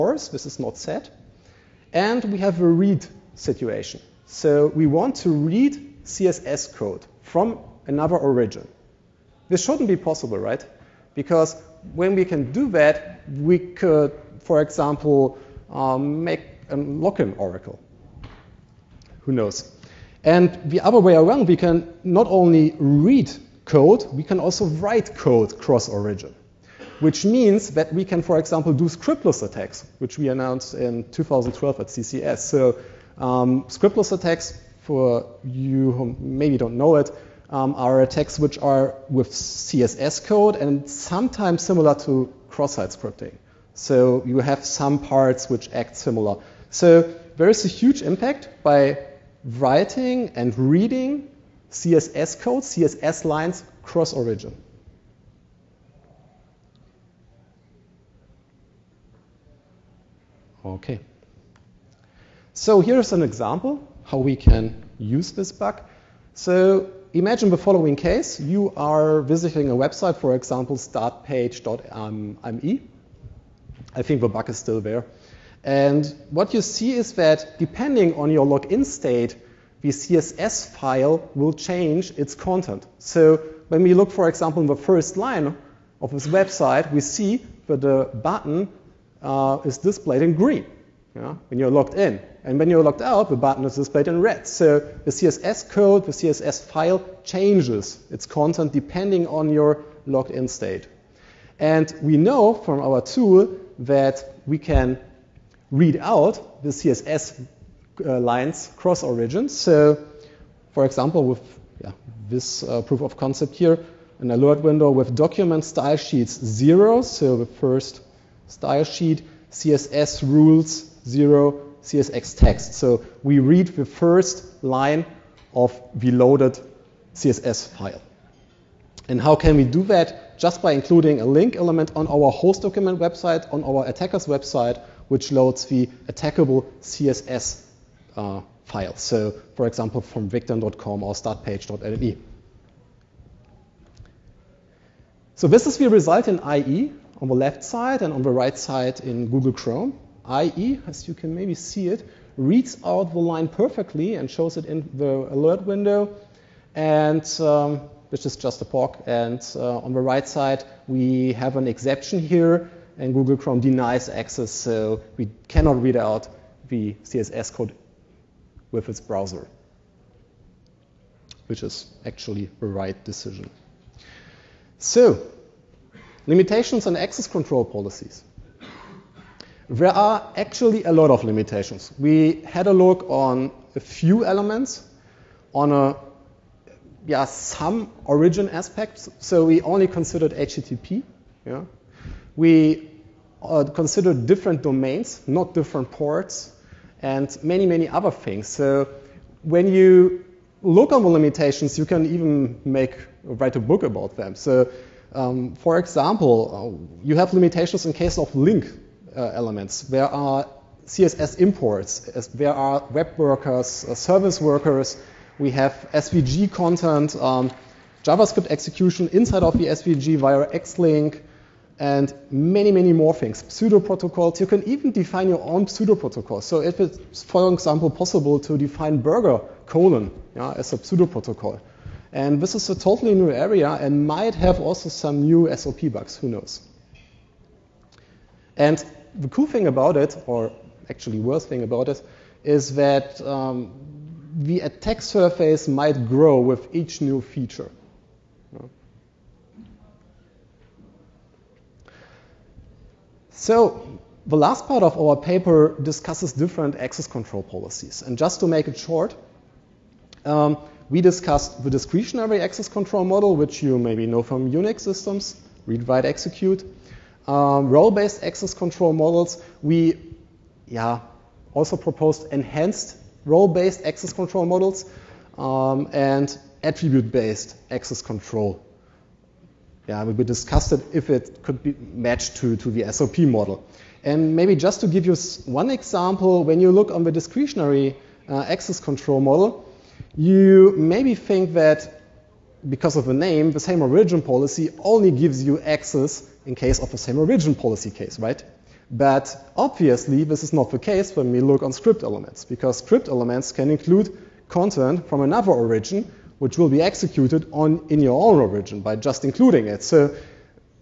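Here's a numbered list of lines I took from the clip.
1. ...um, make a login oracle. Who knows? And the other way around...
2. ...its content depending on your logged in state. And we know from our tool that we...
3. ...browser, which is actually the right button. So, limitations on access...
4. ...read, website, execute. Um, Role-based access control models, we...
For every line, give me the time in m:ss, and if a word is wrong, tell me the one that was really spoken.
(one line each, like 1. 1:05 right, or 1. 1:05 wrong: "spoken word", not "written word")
1. 0:15 right
2. 1:38 right
3. 2:48 wrong: "decision", not "button"
4. 4:25 wrong: "write", not "website".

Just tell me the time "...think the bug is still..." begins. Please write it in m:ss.
1:14.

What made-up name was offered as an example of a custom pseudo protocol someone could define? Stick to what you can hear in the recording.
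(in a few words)
burger.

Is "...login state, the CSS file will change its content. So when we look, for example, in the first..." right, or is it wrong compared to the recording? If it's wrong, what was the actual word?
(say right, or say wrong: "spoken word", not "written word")
right.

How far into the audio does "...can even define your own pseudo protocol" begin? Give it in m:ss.
3:44.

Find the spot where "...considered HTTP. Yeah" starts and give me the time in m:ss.
3:09.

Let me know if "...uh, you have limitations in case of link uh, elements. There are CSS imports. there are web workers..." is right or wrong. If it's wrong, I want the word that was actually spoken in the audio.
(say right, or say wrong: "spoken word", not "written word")
right.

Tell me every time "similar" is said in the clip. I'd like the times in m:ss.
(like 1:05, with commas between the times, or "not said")
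0:41, 0:45.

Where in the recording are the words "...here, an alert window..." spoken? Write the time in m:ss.
1:53.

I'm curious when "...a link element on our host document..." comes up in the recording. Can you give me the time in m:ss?
2:11.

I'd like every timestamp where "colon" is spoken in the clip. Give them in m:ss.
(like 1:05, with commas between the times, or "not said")
3:49.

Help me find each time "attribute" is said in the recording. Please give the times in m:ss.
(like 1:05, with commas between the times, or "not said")
4:36.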